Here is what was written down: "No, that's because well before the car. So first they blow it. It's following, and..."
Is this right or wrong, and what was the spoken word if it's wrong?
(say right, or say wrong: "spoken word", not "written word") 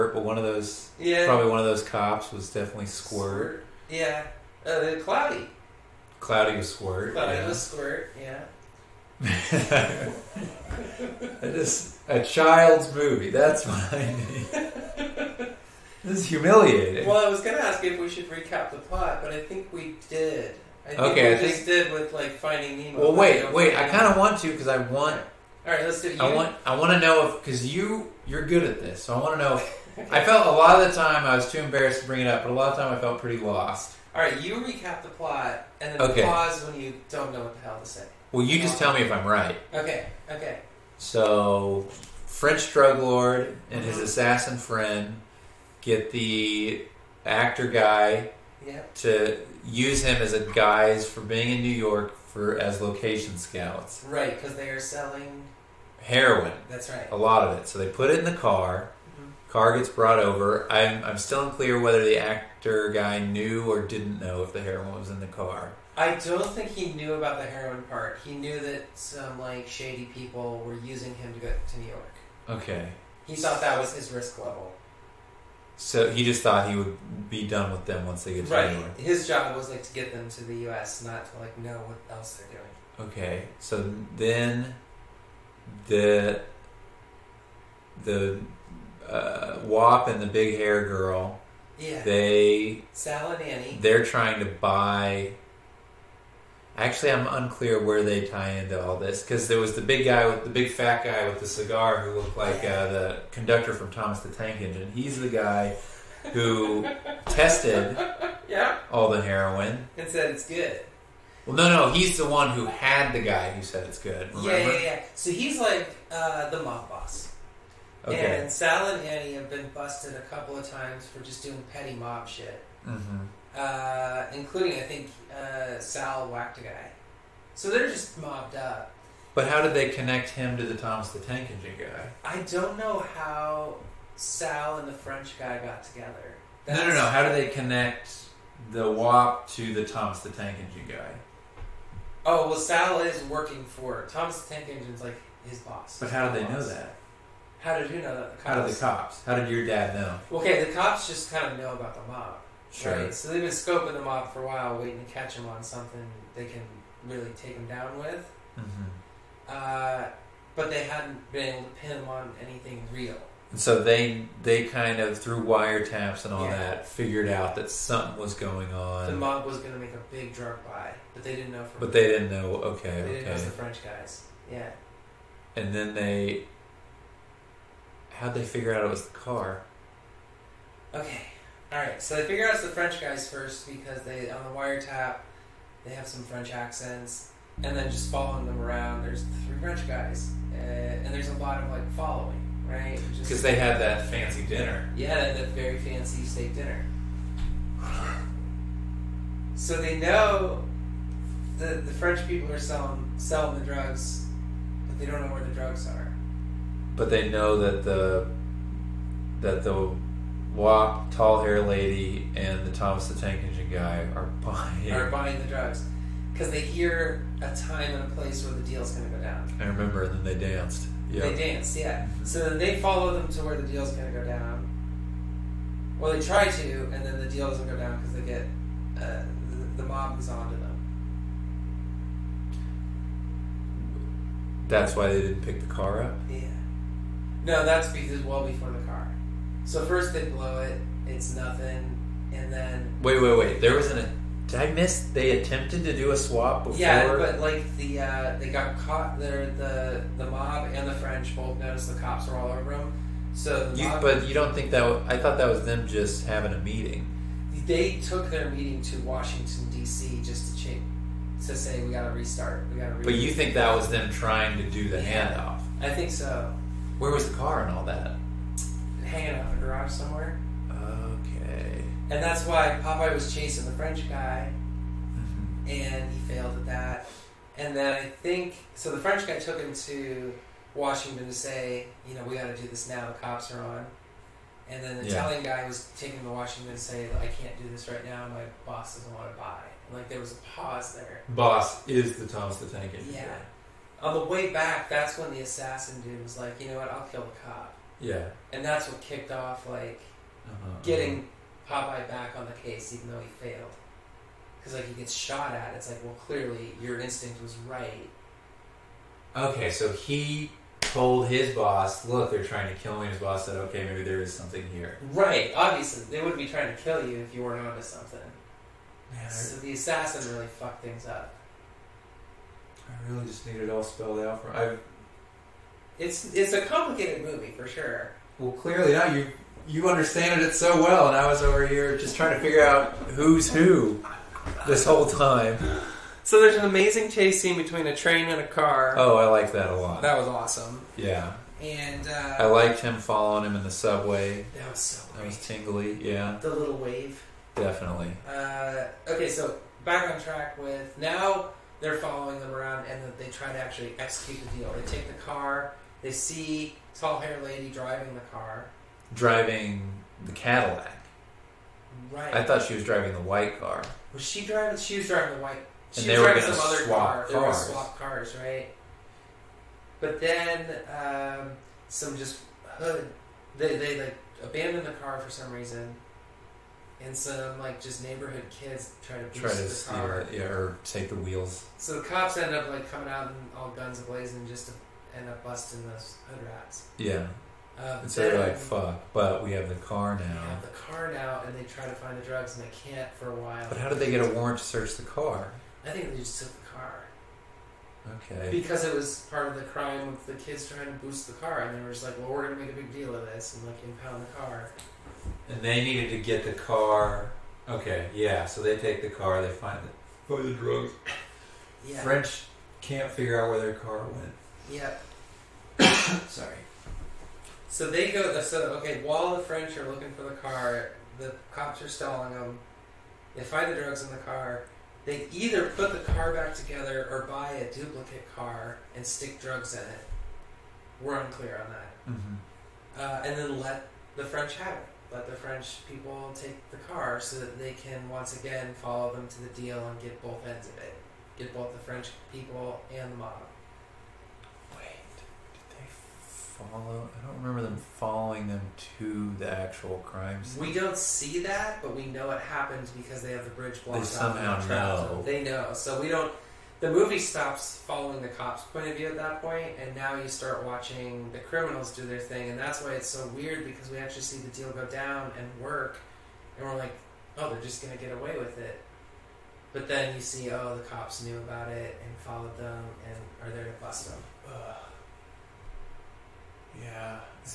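wrong: "nothing", not "following".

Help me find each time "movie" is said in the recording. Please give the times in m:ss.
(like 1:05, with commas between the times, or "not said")
0:12, 5:27, 7:36.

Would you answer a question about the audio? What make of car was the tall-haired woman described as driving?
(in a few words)
Cadillac.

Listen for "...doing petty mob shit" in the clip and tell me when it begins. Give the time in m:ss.
2:01.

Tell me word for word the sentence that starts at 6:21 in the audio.
So the cops end up like coming out and all guns ablazing just to end up busting those hood rats.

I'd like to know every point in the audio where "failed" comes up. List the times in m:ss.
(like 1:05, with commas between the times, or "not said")
4:36, 5:03.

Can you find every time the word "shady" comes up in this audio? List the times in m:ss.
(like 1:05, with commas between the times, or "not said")
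1:09.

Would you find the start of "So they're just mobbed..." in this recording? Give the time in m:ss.
2:07.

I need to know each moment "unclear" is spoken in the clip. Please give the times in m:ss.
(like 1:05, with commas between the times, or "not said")
1:01, 1:37, 7:11.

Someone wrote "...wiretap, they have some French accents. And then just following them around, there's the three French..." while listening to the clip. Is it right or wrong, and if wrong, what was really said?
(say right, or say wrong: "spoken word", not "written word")
right.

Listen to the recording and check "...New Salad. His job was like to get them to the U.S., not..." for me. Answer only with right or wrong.
wrong.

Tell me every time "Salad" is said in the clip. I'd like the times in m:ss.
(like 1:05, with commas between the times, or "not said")
1:32.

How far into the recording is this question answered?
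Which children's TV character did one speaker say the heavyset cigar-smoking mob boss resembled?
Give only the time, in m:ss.
1:42.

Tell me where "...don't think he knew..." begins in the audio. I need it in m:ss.
1:06.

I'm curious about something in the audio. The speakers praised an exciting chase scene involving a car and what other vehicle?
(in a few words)
A train.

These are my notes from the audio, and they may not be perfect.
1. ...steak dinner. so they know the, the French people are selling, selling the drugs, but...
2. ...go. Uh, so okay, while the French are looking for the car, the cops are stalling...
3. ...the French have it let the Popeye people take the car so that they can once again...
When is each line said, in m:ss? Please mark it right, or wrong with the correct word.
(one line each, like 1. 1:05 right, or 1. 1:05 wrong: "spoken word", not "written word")
1. 3:16 right
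2. 6:58 right
3. 7:14 wrong: "French", not "Popeye".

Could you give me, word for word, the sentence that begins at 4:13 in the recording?
So, the you, mob, but you don't think that?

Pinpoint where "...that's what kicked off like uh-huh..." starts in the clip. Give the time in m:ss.
4:58.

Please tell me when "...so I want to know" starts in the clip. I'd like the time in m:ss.
0:29.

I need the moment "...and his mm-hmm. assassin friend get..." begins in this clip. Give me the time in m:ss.
0:43.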